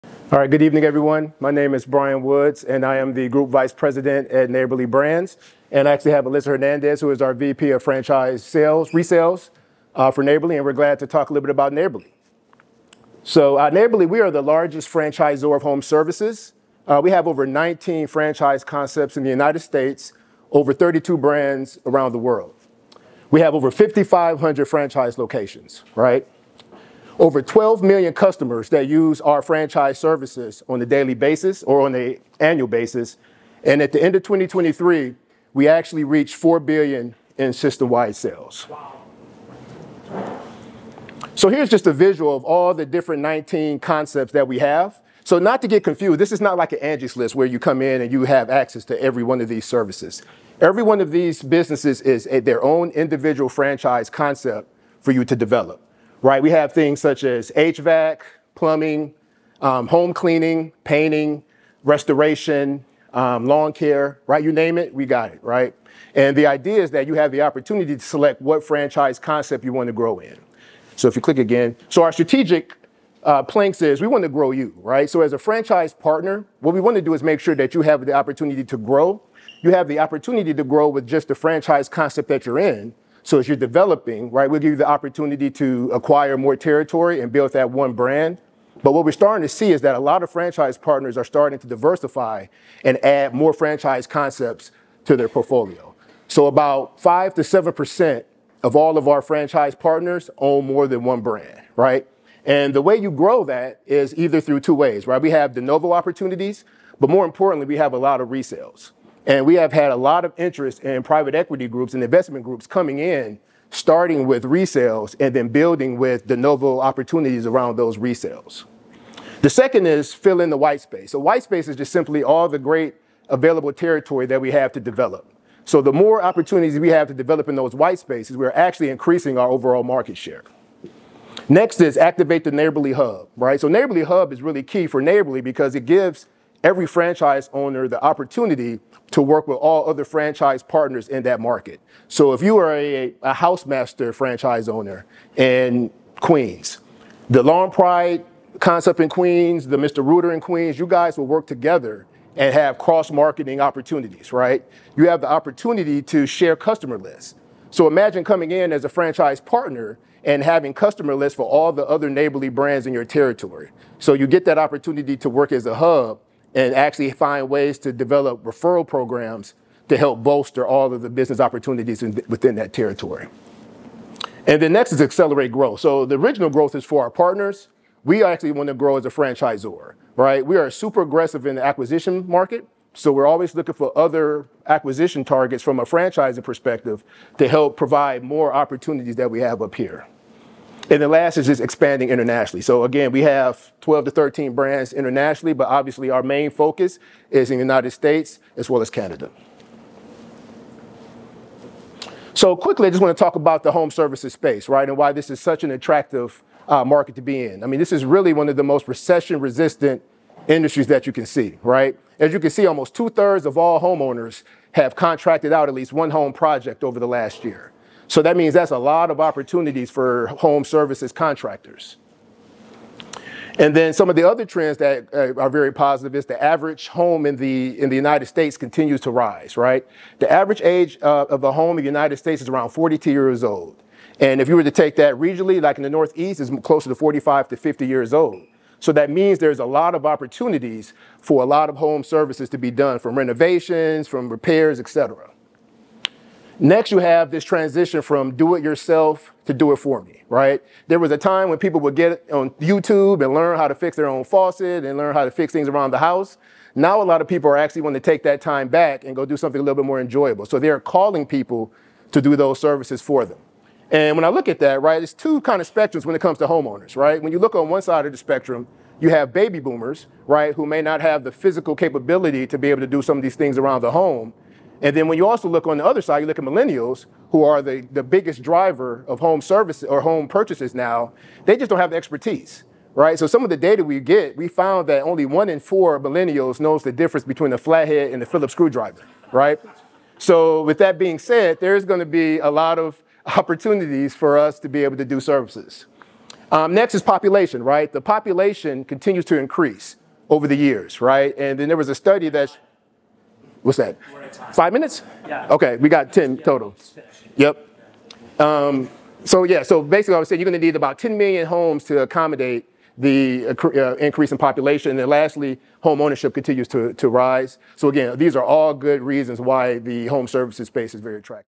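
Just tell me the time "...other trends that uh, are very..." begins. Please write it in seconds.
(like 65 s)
224 s.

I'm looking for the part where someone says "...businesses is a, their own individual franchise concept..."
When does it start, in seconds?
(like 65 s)
51 s.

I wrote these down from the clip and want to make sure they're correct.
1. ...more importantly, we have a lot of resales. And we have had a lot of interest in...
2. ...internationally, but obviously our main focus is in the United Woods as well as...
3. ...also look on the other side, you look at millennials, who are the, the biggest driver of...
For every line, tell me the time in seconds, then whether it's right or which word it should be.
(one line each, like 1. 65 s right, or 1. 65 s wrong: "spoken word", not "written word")
1. 107 s right
2. 194 s wrong: "States", not "Woods"
3. 275 s right.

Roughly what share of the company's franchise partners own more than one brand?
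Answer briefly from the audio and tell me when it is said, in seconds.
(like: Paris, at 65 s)
5 to 7 percent, at 96 s.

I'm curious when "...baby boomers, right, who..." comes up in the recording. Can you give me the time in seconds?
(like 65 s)
269 s.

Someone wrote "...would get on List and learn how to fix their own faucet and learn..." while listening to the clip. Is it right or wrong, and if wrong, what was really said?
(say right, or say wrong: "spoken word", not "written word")
wrong: "YouTube", not "List".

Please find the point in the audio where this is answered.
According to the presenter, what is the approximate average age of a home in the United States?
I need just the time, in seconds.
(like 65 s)
232 s.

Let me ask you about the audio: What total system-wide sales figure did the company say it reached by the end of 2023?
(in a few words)
4 billion.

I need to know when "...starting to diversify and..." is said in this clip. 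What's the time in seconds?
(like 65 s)
91 s.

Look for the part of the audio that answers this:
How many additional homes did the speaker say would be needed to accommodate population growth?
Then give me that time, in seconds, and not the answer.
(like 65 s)
310 s.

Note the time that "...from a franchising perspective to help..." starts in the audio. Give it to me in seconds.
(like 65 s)
185 s.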